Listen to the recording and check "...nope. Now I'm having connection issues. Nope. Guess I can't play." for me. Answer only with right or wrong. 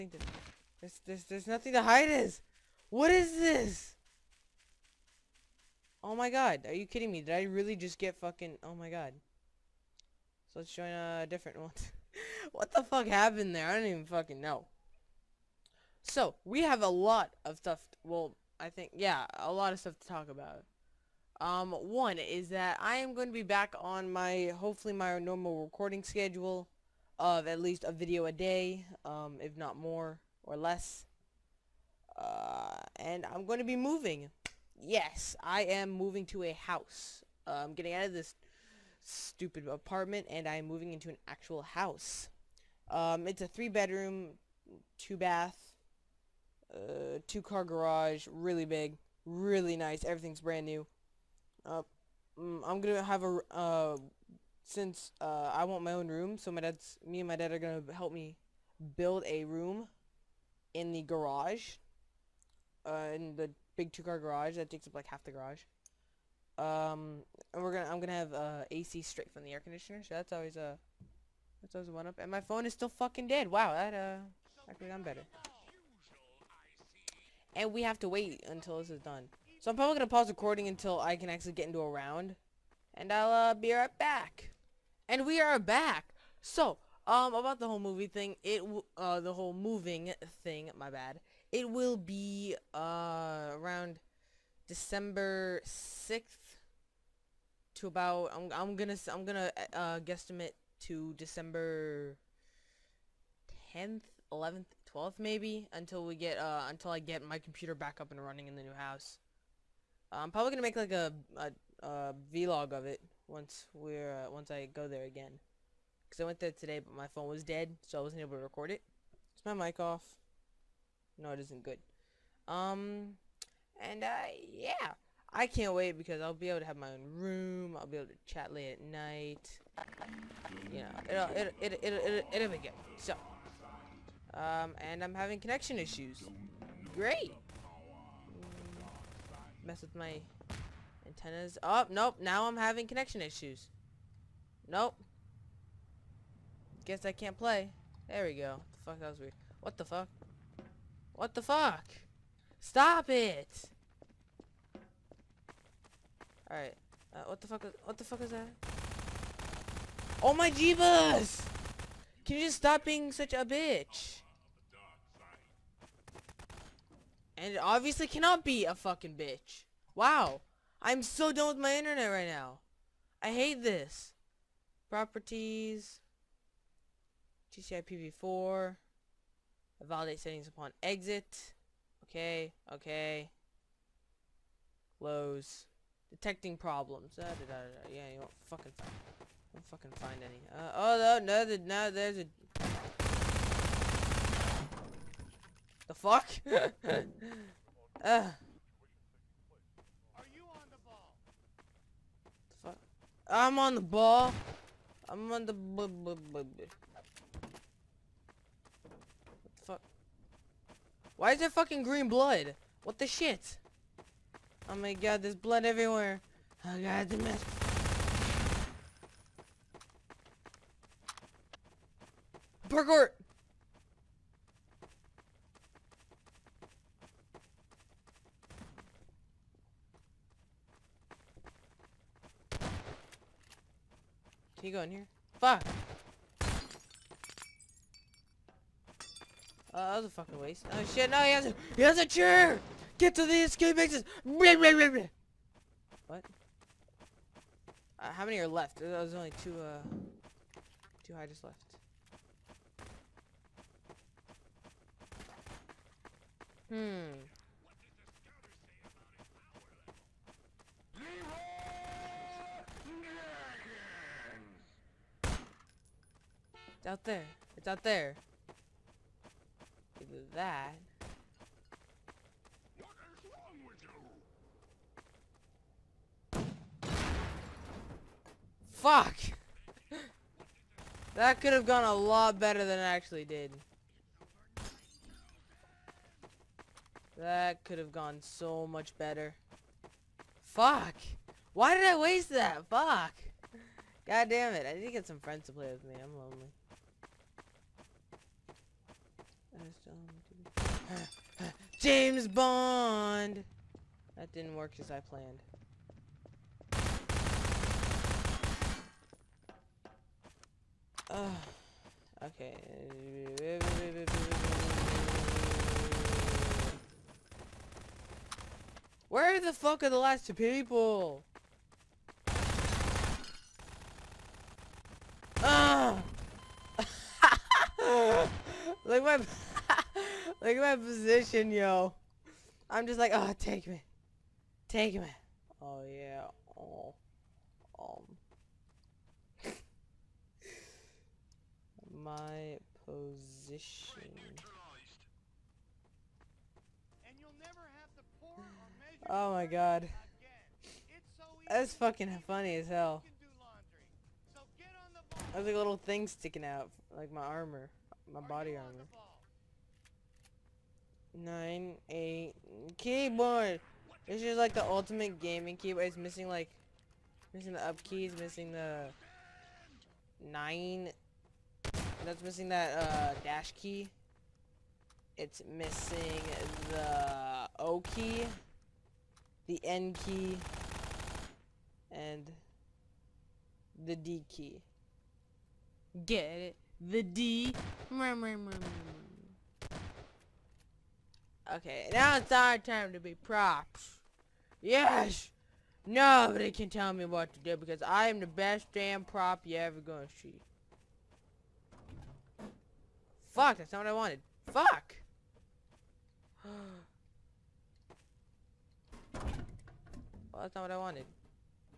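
right.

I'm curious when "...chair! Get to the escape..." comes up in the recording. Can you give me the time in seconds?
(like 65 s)
242 s.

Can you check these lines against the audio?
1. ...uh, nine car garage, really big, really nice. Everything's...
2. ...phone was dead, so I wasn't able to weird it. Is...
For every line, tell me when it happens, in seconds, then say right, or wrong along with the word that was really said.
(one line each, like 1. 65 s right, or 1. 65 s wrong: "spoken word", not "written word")
1. 46 s wrong: "two", not "nine"
2. 117 s wrong: "record", not "weird".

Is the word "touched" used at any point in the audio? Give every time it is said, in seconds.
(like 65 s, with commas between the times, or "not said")
not said.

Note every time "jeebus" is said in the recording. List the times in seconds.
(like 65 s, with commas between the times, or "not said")
160 s.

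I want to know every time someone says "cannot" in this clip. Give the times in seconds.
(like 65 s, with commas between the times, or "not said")
168 s.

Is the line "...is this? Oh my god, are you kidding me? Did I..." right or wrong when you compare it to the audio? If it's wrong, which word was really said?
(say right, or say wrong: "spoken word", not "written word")
right.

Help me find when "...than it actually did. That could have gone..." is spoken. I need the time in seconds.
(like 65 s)
282 s.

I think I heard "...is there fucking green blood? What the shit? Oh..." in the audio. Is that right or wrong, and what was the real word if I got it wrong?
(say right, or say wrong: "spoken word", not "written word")
right.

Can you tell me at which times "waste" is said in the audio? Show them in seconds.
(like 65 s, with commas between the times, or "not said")
240 s, 291 s.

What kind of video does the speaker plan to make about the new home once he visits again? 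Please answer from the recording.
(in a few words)
a vlog.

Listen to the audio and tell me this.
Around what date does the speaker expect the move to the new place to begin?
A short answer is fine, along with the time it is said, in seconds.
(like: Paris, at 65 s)
December 6th, at 94 s.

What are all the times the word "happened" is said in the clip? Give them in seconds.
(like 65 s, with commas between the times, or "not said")
13 s.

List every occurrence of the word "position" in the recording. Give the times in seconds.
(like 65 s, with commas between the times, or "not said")
330 s, 342 s.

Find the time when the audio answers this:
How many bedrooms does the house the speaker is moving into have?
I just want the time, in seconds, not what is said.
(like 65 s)
43 s.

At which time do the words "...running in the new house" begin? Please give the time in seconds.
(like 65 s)
108 s.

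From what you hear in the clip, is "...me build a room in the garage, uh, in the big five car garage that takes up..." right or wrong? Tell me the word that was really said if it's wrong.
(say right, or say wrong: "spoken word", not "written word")
wrong: "two", not "five".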